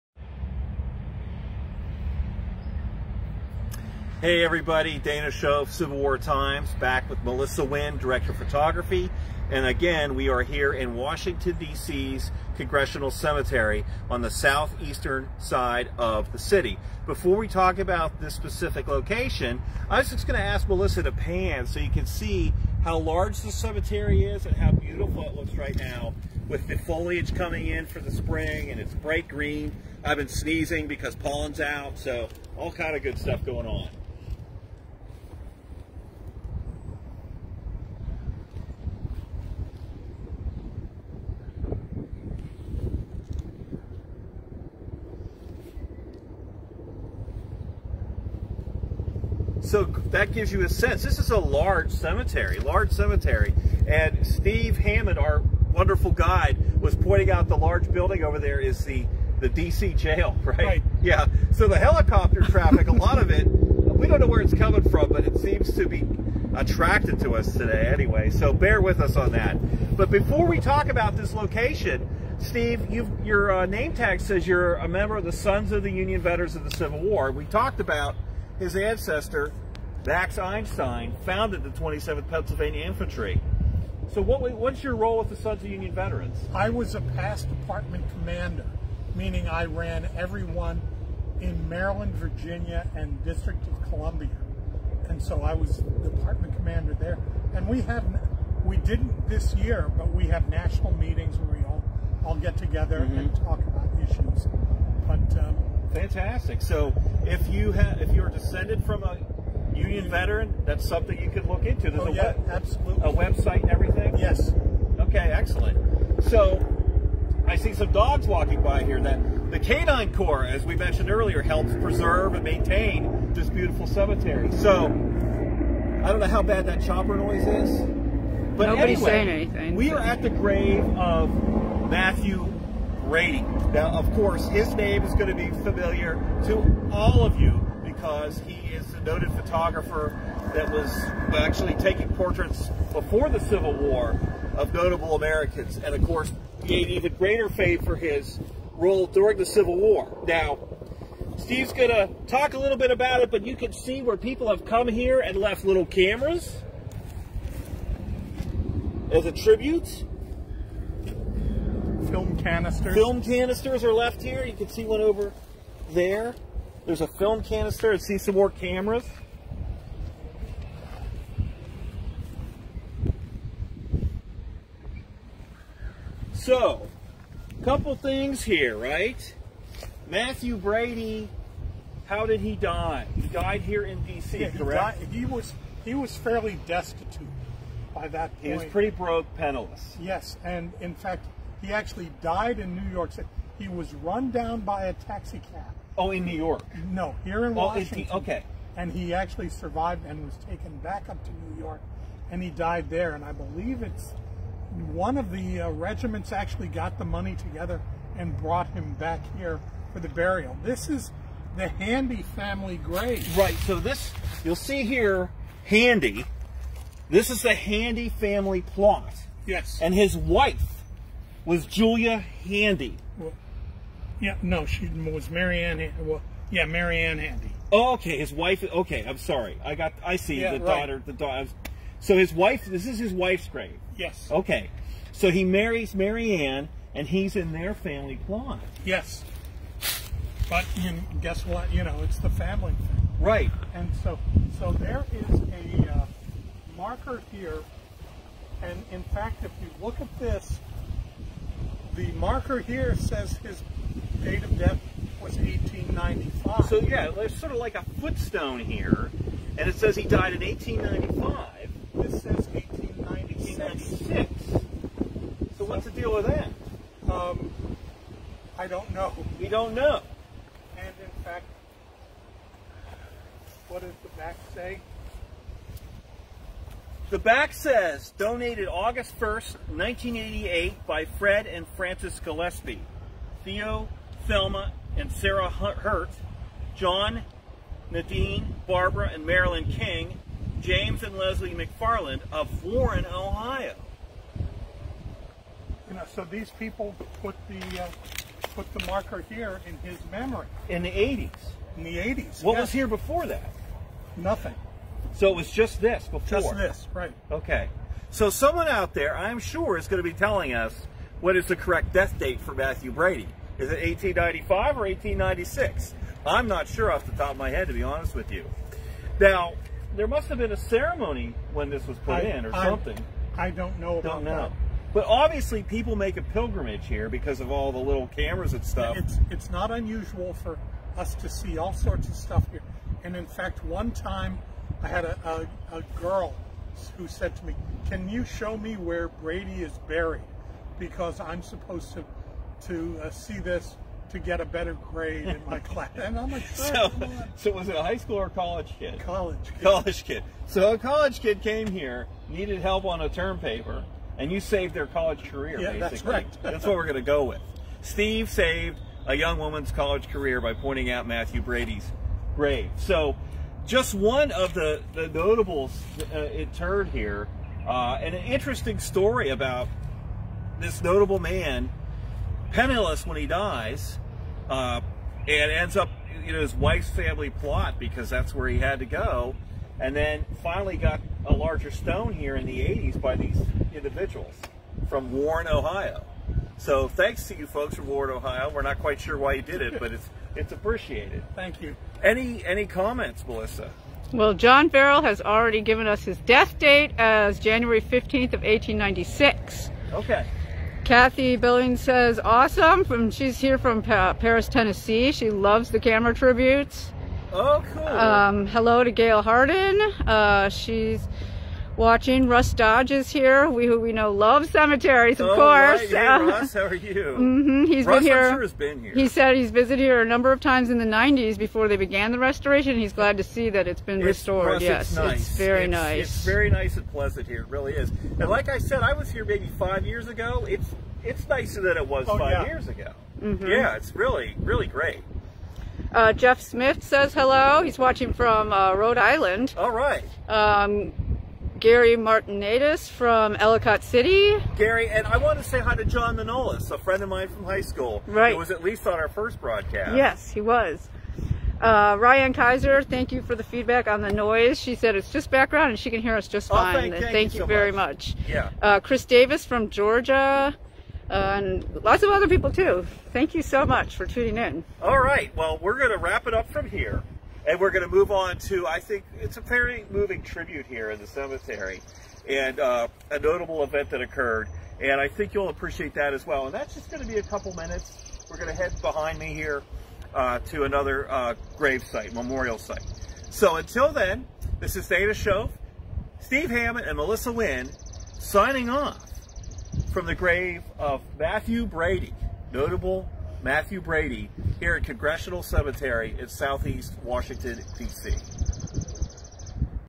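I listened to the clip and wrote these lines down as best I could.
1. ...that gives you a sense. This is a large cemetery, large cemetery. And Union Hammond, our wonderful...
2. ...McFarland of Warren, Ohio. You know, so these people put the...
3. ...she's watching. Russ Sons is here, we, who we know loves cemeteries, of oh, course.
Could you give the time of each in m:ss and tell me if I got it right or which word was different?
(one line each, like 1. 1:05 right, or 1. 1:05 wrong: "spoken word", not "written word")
1. 0:50 wrong: "Steve", not "Union"
2. 4:51 right
3. 6:50 wrong: "Dodge", not "Sons".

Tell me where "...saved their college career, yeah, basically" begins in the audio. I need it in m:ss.
5:54.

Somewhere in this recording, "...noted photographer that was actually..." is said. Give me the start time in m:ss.
2:19.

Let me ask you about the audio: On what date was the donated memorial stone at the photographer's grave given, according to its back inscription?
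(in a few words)
August 1, 1988.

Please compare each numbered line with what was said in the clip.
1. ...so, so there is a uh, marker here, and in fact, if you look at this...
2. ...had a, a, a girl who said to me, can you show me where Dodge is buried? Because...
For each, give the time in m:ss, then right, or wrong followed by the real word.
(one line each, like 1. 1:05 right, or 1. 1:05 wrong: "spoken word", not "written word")
1. 4:04 right
2. 5:34 wrong: "Brady", not "Dodge".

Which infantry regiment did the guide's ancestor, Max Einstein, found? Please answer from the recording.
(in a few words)
27th Pennsylvania Infantry.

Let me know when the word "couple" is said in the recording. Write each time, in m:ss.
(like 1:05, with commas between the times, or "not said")
2:57, 7:57.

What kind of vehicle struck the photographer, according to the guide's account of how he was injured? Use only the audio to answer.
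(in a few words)
A taxi cab.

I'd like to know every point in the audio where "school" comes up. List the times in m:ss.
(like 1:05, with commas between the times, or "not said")
5:47, 7:27.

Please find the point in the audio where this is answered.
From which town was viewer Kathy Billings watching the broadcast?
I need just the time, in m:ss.
6:44.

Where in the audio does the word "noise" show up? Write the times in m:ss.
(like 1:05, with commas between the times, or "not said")
2:07, 7:34.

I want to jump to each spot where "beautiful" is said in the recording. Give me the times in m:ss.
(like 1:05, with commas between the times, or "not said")
0:24, 2:03.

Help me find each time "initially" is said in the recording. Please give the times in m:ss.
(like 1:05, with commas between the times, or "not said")
not said.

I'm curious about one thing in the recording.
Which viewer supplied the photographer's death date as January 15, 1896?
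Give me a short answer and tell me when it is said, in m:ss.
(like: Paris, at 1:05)
John Farrell, at 6:34.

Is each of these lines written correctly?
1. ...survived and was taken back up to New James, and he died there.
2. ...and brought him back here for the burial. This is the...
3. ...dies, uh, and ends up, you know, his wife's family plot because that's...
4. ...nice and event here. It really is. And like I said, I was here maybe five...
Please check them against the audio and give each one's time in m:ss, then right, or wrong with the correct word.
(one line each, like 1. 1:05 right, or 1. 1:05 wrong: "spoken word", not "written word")
1. 3:19 wrong: "York", not "James"
2. 3:28 right
3. 6:13 right
4. 7:06 wrong: "pleasant", not "event".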